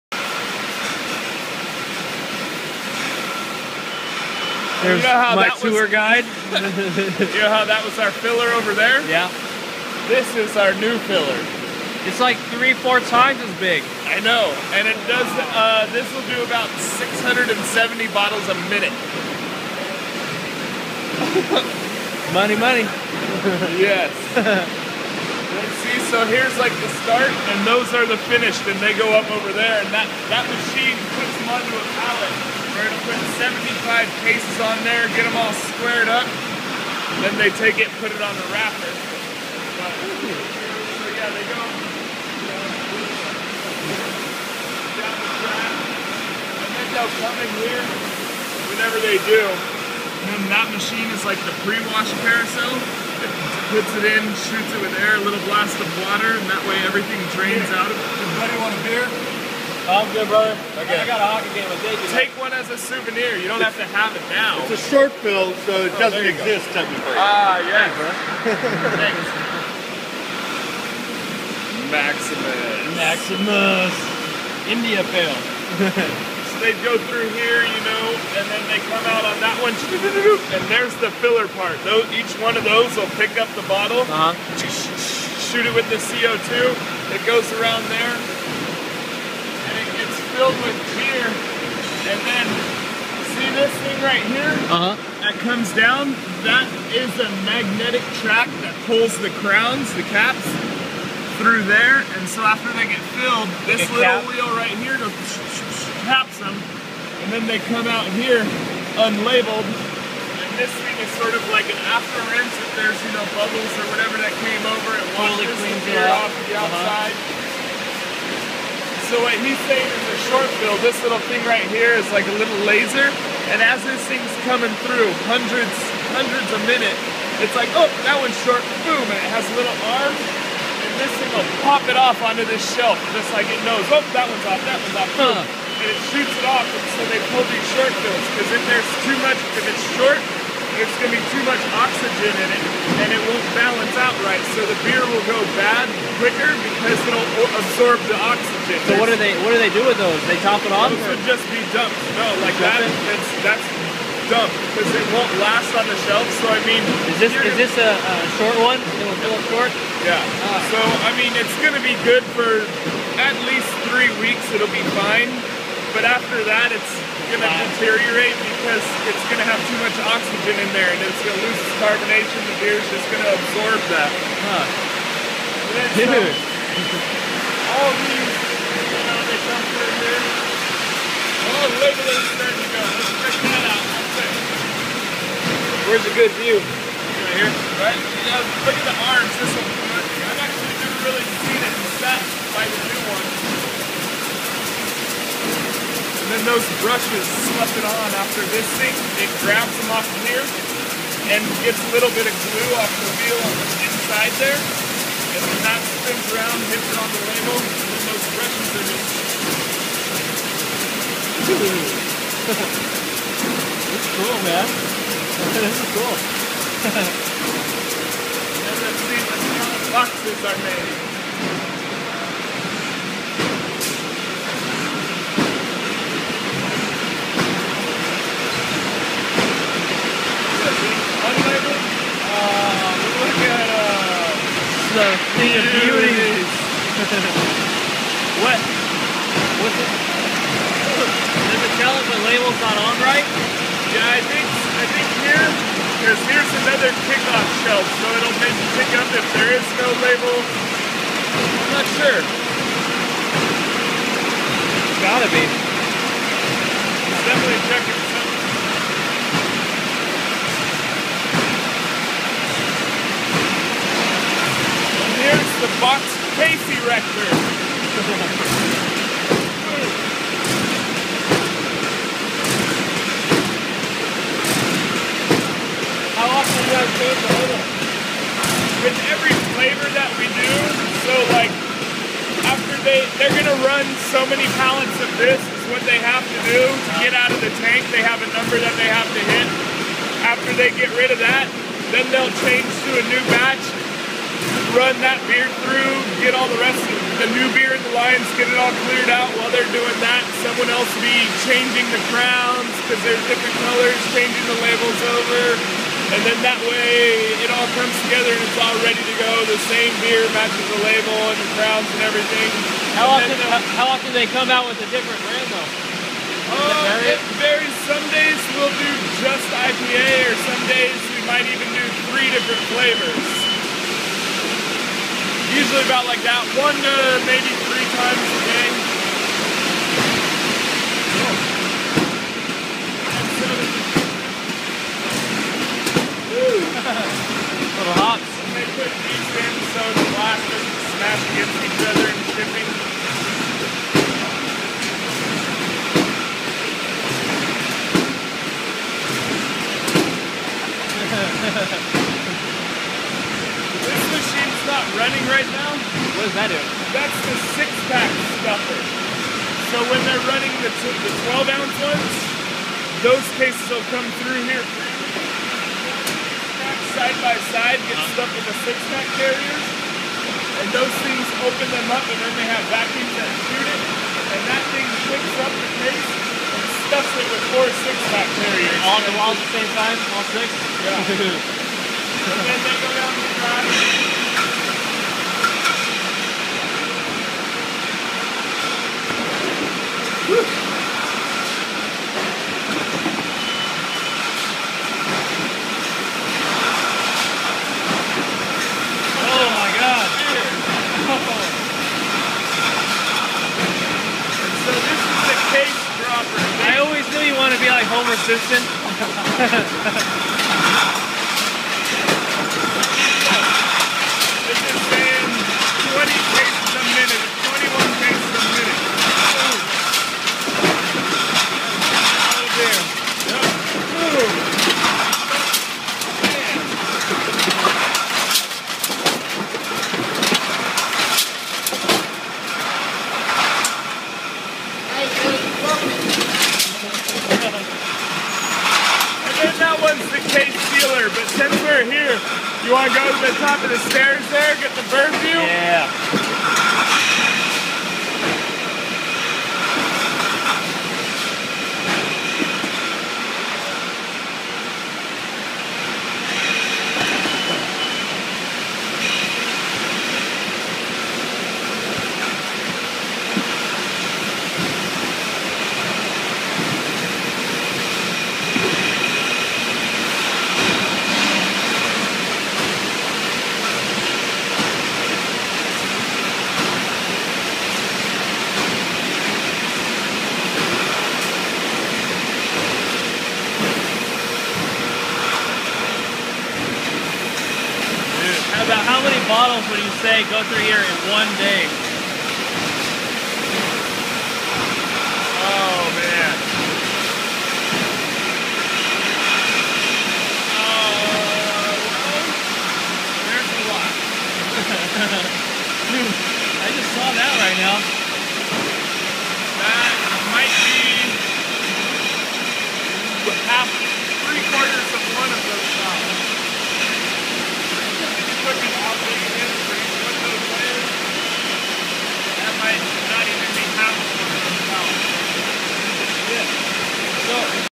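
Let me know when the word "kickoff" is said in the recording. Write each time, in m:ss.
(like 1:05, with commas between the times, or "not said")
4:07.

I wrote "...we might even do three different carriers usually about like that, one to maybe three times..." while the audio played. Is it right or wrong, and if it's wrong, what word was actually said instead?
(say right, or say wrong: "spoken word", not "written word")
wrong: "flavors", not "carriers".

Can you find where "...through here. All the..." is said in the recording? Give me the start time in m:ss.
2:59.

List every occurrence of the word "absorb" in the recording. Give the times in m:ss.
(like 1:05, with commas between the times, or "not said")
2:27, 2:53.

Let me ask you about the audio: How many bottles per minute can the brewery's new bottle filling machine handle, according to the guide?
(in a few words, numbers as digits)
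670.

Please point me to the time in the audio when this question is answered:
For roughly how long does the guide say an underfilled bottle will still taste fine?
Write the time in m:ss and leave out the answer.
2:43.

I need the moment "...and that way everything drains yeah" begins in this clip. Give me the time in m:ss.
0:56.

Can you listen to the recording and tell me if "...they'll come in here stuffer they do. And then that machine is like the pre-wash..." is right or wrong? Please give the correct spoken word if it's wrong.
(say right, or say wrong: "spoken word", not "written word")
wrong: "whenever", not "stuffer".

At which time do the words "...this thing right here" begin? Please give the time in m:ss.
1:33.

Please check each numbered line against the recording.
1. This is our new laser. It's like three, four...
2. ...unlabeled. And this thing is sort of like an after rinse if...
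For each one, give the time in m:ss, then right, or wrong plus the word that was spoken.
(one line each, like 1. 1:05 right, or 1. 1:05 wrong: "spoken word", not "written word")
1. 0:10 wrong: "filler", not "laser"
2. 1:48 right.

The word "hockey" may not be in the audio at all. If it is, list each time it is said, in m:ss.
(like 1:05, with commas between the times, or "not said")
1:01.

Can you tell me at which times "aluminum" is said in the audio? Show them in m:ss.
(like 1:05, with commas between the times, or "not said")
not said.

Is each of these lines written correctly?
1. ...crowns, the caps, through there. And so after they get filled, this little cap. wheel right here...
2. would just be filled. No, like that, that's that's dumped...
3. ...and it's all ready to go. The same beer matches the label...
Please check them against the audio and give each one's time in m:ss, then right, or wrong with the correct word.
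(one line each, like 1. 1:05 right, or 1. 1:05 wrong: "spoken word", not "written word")
1. 1:39 right
2. 2:31 wrong: "dumped", not "filled"
3. 5:08 right.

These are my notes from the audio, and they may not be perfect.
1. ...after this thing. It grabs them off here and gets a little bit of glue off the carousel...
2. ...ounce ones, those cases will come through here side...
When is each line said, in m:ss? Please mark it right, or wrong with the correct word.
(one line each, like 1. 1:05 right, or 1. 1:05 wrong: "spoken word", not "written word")
1. 3:18 wrong: "wheel", not "carousel"
2. 6:01 right.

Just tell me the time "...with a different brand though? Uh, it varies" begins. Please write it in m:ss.
5:14.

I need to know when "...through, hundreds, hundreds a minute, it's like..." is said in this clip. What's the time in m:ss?
2:04.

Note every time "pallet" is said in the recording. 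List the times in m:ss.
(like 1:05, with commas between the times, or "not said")
0:32, 4:44.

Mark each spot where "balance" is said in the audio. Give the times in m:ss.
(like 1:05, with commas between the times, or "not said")
2:23.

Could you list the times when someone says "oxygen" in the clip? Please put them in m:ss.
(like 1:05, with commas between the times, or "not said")
2:21, 2:28, 2:50.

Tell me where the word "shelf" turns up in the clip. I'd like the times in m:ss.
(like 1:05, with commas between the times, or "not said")
2:12, 2:36, 4:07.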